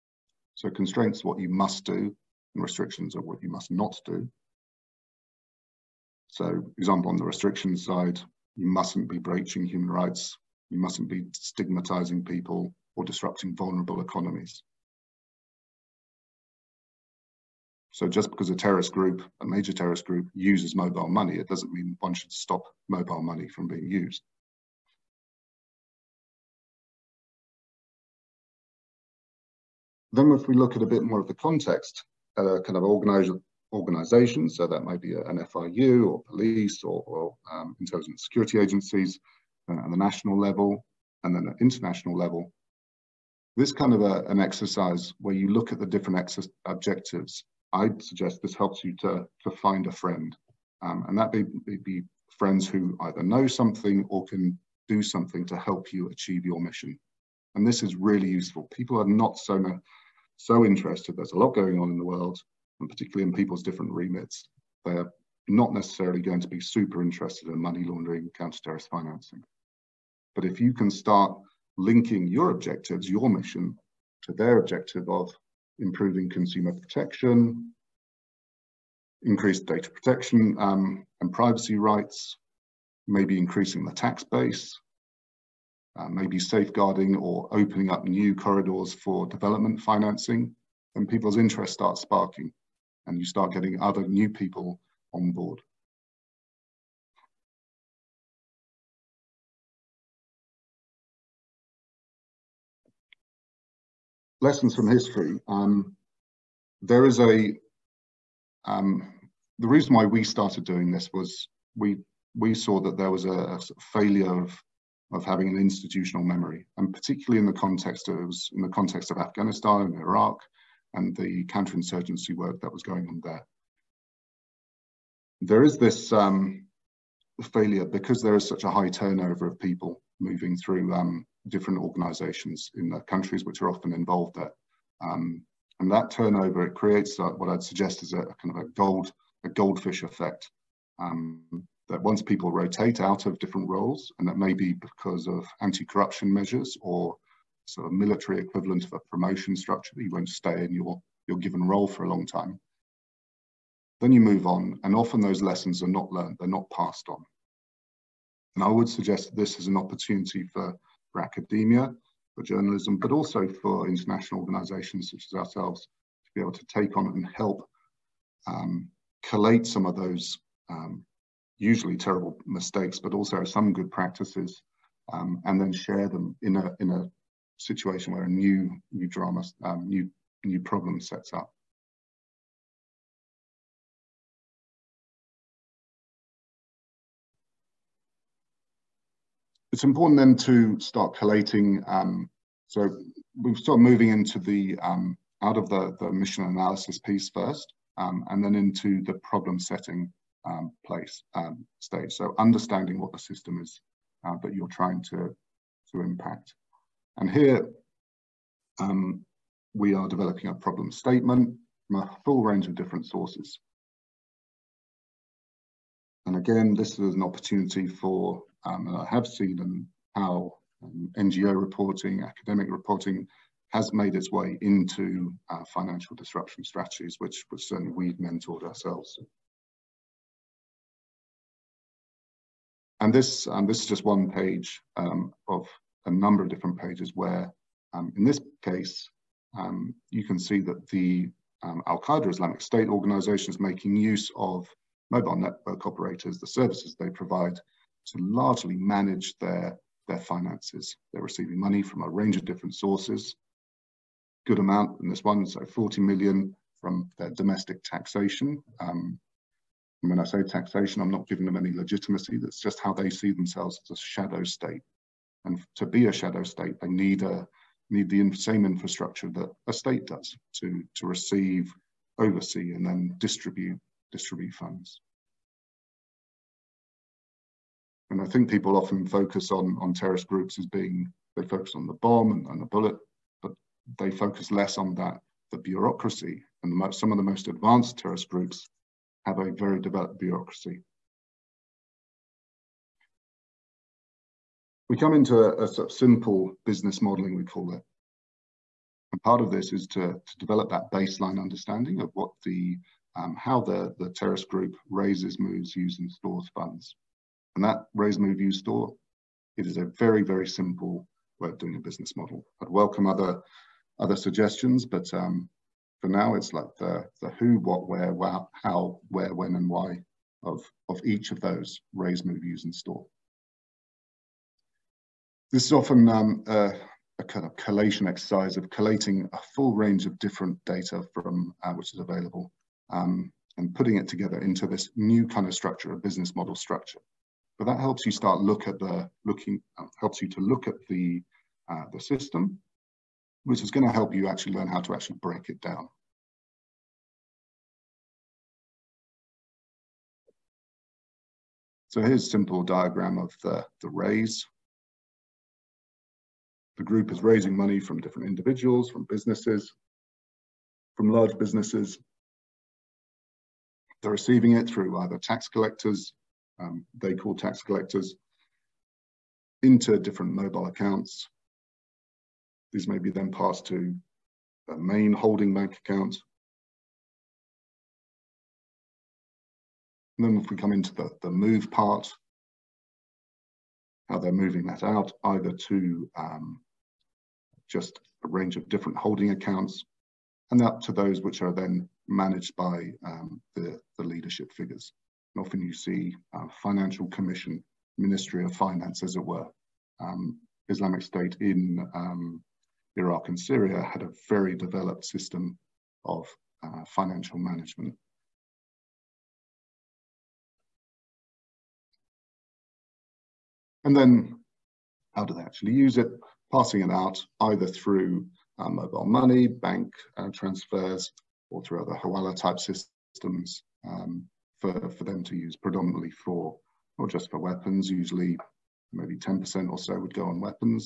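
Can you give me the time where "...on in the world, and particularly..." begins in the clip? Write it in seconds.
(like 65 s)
61 s.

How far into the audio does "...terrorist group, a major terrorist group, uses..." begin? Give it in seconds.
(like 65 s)
18 s.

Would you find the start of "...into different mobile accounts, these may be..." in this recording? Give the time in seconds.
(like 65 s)
369 s.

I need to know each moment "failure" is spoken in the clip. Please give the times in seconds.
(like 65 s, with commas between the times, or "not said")
113 s, 127 s.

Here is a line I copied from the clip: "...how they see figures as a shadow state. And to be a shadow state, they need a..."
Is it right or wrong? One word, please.
wrong.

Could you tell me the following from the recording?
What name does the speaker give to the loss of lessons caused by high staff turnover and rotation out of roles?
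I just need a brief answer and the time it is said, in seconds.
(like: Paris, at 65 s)
goldfish effect, at 139 s.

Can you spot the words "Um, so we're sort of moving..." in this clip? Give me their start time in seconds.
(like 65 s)
191 s.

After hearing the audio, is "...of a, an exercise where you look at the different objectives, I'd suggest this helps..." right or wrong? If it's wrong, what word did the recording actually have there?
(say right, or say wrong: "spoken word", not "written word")
right.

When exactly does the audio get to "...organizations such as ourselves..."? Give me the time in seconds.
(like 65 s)
164 s.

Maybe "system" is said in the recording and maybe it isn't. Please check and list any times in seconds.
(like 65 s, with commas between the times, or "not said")
203 s, 341 s, 405 s, 422 s.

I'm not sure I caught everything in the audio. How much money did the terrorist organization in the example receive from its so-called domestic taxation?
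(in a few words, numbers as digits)
40 million.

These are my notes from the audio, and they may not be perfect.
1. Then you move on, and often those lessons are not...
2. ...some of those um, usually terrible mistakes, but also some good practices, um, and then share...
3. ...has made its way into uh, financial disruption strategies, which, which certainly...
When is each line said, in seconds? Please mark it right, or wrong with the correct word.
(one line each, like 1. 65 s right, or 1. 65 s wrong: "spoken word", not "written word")
1. 154 s right
2. 169 s right
3. 223 s right.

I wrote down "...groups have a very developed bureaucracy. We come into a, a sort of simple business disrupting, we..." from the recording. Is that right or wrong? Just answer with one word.
wrong.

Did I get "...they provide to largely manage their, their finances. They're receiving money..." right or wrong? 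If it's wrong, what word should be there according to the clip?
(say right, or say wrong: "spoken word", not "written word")
right.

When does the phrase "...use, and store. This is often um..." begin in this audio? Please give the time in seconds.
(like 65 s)
322 s.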